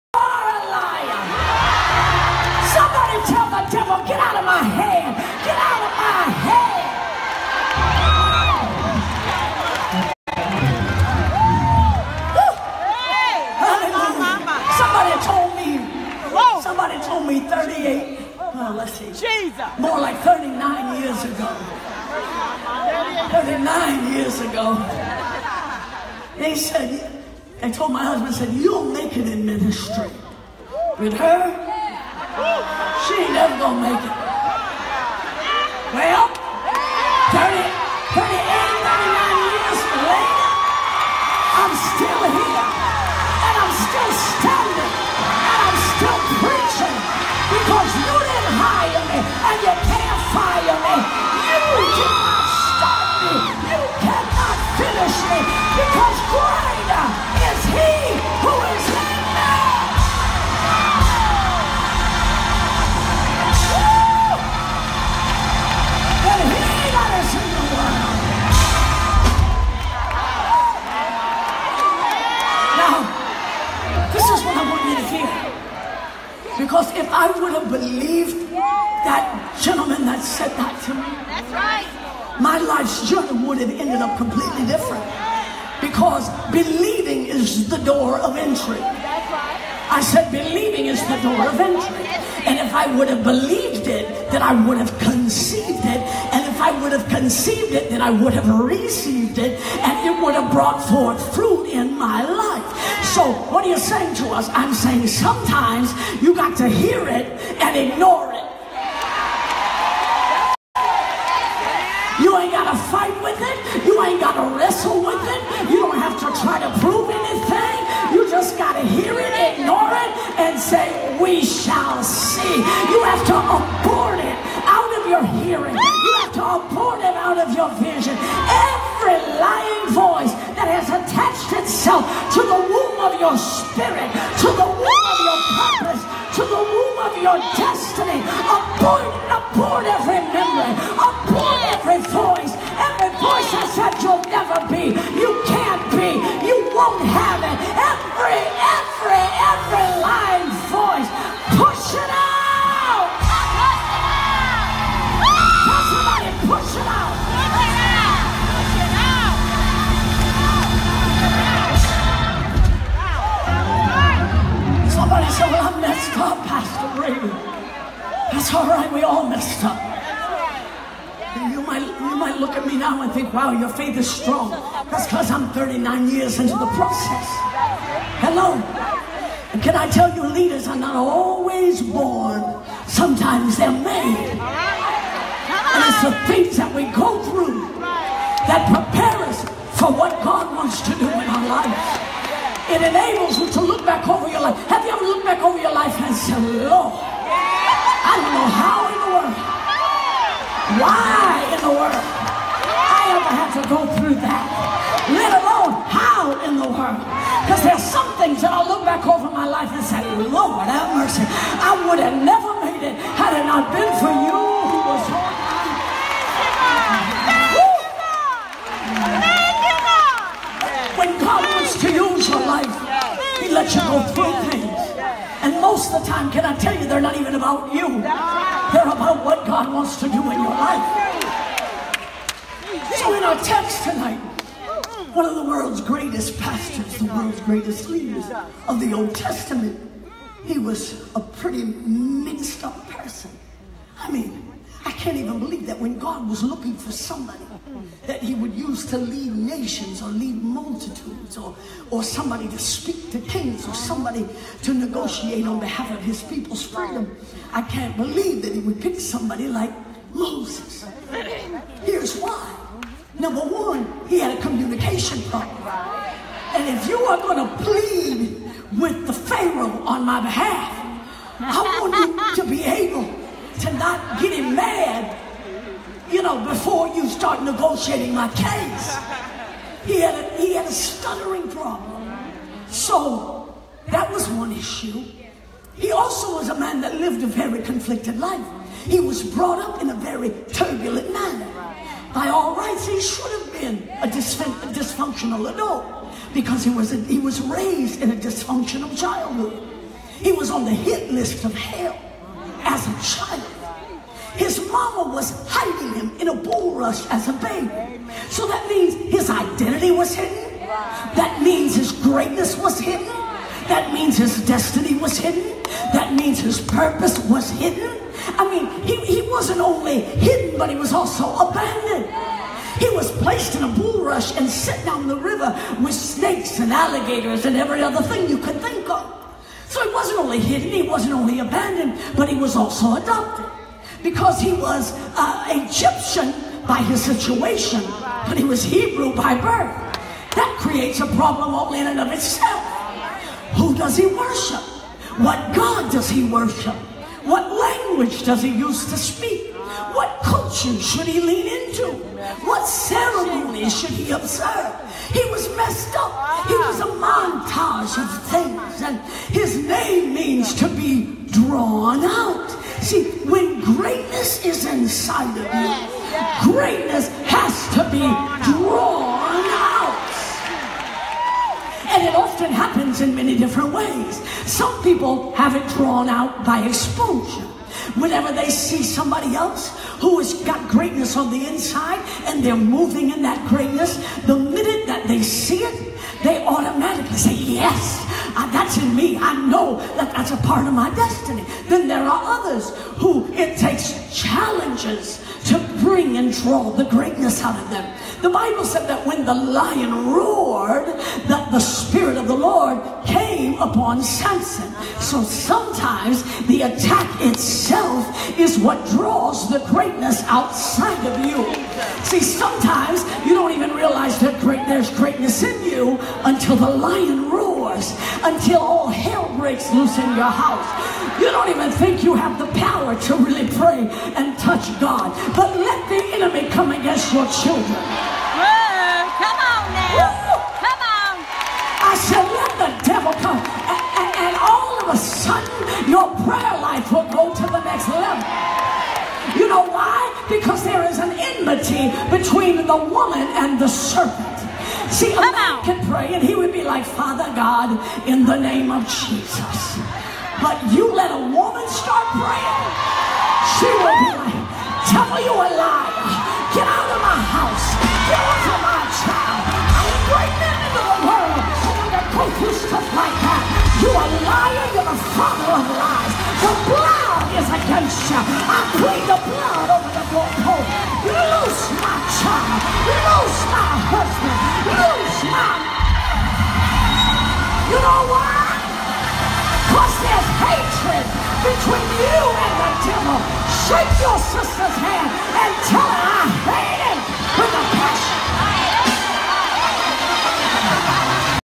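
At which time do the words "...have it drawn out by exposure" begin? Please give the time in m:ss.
6:15.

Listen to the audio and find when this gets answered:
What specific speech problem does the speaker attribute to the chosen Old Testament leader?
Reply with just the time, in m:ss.
4:40.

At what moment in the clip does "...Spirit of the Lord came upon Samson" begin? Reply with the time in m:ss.
6:41.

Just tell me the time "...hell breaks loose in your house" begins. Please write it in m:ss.
6:58.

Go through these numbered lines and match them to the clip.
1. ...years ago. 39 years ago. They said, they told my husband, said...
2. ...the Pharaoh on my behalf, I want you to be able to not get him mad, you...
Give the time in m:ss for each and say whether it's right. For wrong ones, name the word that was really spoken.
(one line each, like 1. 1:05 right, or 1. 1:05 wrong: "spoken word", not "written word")
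1. 0:21 right
2. 4:29 right.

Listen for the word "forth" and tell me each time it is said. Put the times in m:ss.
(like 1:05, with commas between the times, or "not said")
1:40.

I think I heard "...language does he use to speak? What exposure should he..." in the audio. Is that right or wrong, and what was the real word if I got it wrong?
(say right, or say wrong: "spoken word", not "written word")
wrong: "culture", not "exposure".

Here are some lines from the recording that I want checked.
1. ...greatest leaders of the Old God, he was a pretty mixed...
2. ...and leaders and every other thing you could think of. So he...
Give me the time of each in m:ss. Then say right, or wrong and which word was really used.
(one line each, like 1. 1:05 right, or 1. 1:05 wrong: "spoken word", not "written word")
1. 3:57 wrong: "Testament", not "God"
2. 5:26 wrong: "alligators", not "leaders".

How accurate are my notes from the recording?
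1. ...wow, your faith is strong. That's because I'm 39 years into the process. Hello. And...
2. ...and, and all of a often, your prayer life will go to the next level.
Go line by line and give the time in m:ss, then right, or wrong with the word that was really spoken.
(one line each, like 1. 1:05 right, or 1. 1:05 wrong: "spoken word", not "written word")
1. 2:53 right
2. 7:14 wrong: "sudden", not "often".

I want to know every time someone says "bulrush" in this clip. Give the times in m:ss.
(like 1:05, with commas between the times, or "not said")
5:06, 5:23.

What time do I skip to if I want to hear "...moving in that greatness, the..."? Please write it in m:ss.
6:22.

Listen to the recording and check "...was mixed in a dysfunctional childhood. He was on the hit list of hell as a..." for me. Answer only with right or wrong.
wrong.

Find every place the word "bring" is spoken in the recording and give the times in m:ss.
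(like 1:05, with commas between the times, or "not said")
6:35.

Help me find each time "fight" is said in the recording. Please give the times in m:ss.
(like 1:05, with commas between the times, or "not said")
1:52.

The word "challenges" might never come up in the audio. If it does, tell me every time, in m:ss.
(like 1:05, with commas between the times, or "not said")
6:34.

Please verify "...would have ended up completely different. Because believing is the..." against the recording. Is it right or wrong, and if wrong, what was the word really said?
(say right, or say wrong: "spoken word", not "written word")
right.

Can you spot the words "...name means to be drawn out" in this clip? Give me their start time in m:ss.
5:59.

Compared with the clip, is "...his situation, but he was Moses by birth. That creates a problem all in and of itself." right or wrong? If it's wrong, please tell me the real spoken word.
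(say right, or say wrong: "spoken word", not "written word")
wrong: "Hebrew", not "Moses".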